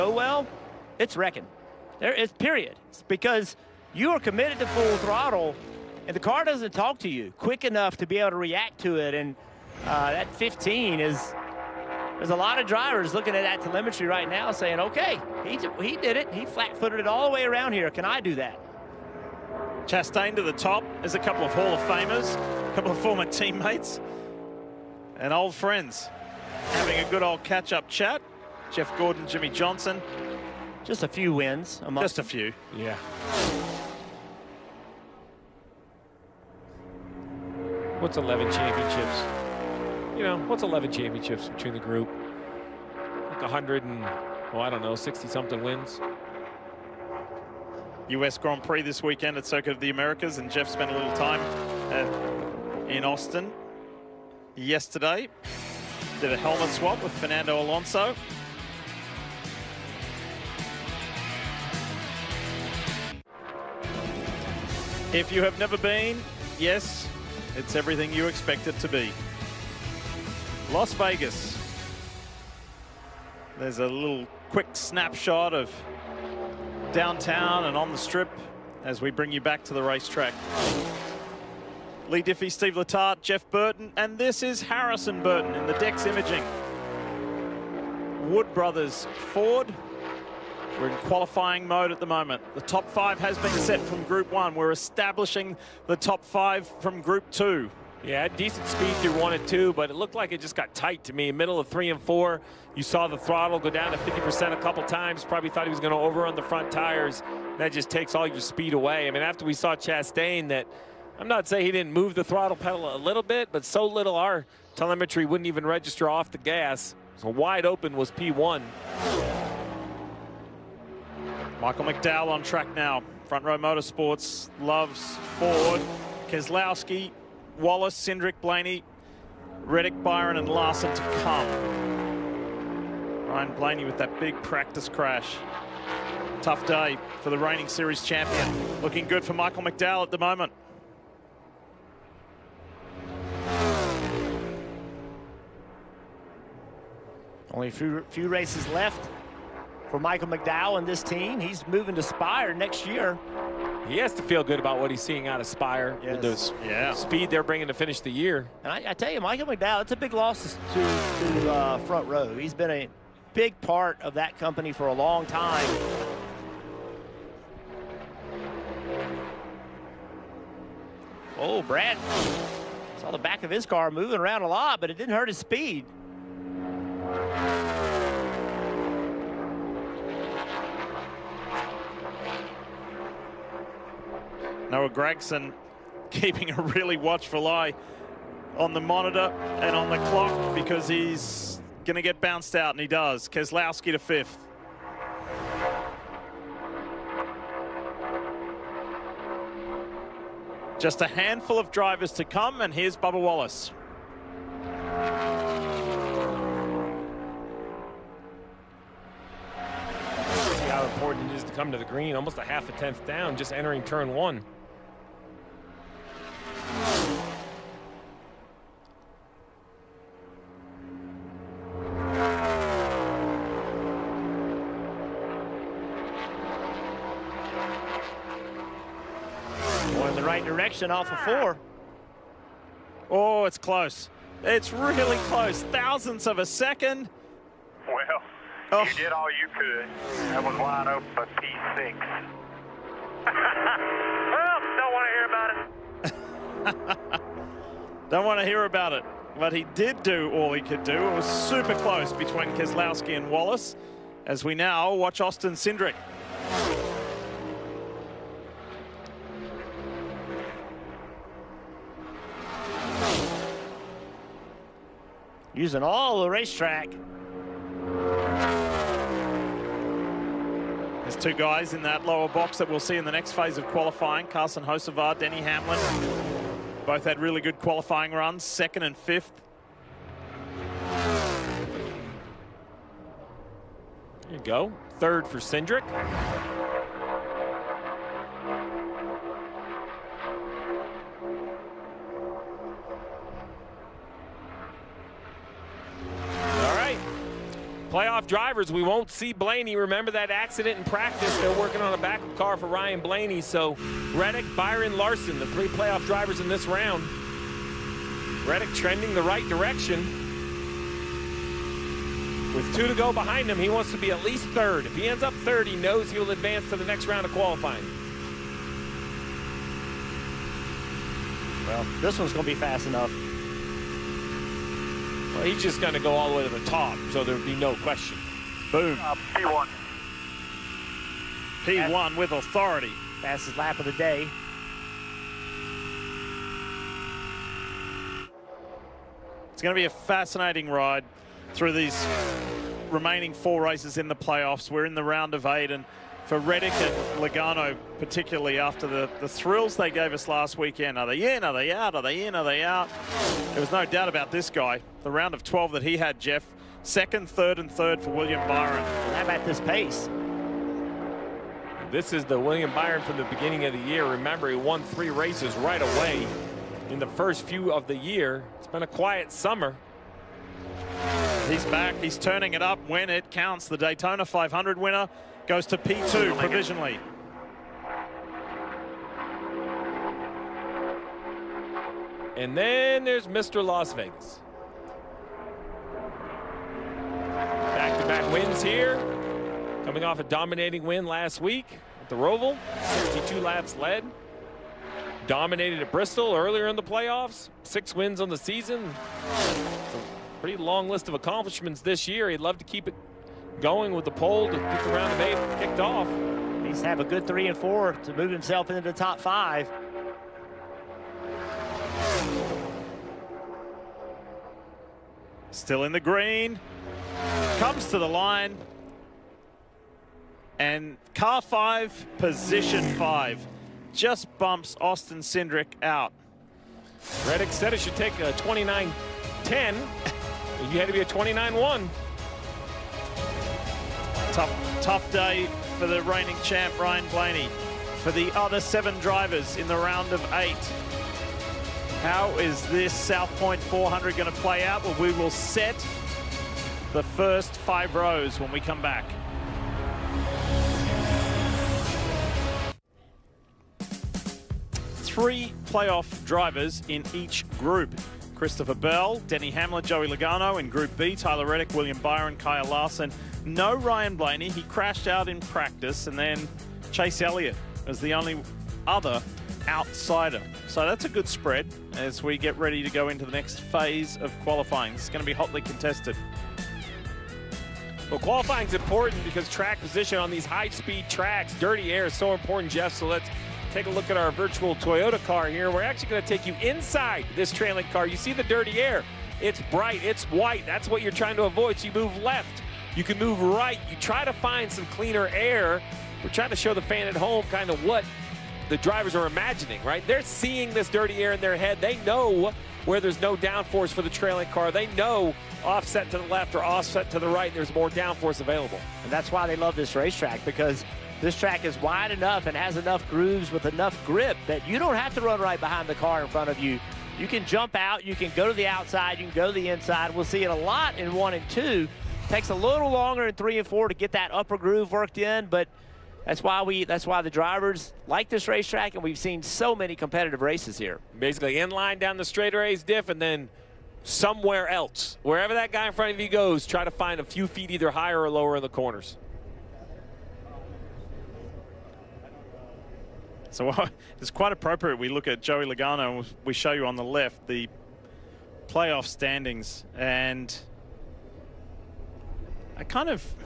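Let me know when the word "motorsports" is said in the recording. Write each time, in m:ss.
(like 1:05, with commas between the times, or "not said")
2:03.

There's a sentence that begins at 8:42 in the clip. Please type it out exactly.
Takes a little longer in three and four to get that upper groove worked in, but that's why we.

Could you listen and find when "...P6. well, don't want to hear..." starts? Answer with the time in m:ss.
4:01.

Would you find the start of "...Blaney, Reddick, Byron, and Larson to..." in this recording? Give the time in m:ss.
2:08.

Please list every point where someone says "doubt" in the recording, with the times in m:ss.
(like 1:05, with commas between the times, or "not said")
5:53.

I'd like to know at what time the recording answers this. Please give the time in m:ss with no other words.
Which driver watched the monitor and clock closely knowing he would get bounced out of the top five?
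3:04.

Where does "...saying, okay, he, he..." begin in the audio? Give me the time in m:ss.
0:14.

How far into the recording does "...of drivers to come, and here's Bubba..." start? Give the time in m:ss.
3:21.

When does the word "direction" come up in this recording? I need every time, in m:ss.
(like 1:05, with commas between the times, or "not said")
3:50, 5:09.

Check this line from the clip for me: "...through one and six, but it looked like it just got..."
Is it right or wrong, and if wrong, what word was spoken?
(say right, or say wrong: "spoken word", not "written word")
wrong: "two", not "six".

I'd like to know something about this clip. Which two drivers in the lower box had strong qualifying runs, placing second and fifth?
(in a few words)
Carson Hocevar, Denny Hamlin.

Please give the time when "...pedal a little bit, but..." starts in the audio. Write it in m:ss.
1:52.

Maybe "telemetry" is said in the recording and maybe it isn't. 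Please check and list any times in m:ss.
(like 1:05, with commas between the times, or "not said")
0:13, 1:54.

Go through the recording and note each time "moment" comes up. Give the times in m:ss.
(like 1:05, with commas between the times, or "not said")
1:32, 2:20.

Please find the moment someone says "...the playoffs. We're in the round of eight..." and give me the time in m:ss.
5:44.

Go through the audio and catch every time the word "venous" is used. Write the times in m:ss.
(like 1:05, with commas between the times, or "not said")
not said.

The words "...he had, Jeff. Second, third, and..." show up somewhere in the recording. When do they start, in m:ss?
5:55.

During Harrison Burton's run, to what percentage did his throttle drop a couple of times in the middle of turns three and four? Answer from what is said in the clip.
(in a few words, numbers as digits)
50%.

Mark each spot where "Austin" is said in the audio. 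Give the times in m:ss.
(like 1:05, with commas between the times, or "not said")
0:53, 4:15, 7:04.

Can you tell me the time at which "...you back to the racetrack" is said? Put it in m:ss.
1:19.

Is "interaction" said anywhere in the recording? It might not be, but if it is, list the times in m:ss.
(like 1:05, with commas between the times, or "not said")
not said.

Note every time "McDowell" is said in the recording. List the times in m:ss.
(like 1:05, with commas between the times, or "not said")
2:01, 2:19, 2:30, 2:39.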